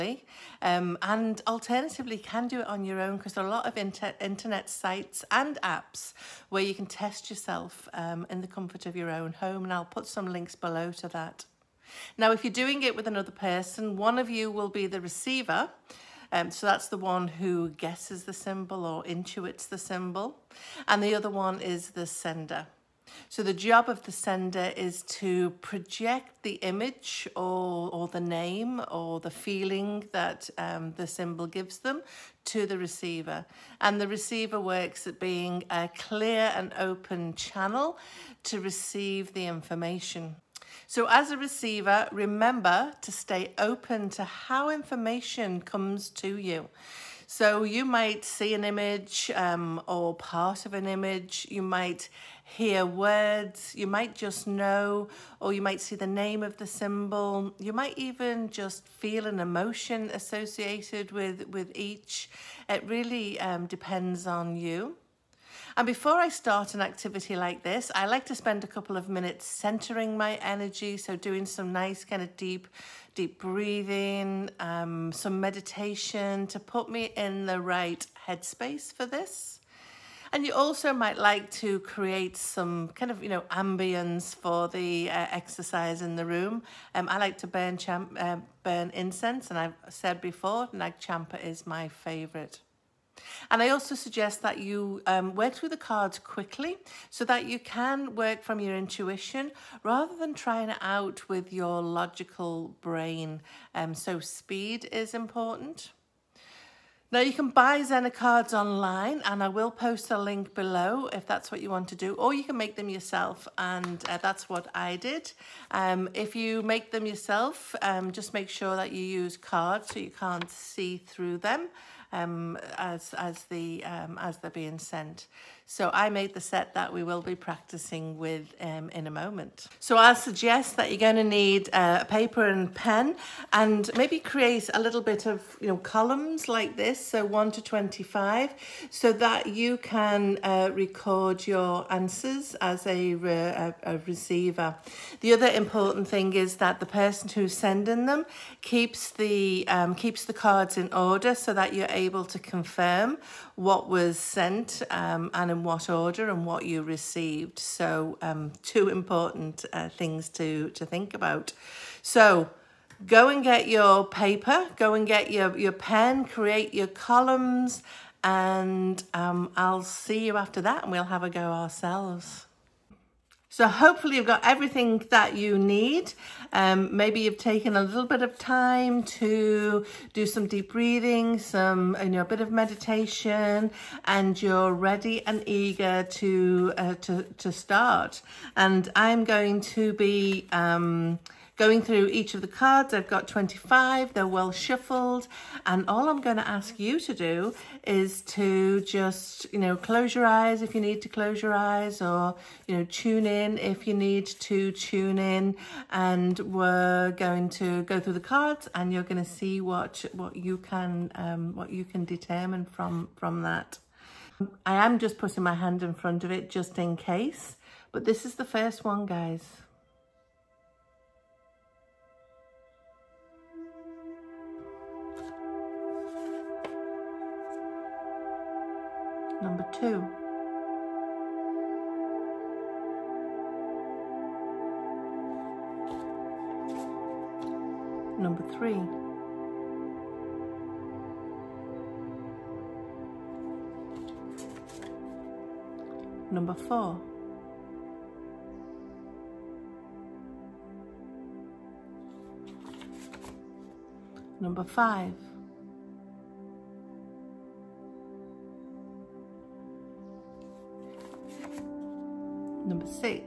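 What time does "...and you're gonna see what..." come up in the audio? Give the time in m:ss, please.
3:28.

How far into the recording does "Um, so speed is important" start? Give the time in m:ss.
1:43.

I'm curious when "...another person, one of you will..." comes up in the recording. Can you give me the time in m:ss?
0:13.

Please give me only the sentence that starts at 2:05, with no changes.
So I made the set that we will be practicing with um, in a moment.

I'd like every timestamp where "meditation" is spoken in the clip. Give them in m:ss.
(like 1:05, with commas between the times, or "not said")
1:15, 3:02.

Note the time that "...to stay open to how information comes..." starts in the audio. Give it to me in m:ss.
0:43.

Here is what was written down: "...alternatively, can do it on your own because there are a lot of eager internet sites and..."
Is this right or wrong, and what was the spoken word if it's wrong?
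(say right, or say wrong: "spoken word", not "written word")
wrong: "inter", not "eager".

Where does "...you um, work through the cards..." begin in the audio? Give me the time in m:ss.
1:34.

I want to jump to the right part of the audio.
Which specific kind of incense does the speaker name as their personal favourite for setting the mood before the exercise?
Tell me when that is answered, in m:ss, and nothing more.
1:30.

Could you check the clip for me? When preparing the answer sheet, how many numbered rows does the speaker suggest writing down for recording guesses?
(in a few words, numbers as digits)
25.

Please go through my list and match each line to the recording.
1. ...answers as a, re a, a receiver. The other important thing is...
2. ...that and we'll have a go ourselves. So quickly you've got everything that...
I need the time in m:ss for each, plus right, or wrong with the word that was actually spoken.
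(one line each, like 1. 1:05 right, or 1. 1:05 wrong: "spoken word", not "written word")
1. 2:21 right
2. 2:50 wrong: "hopefully", not "quickly".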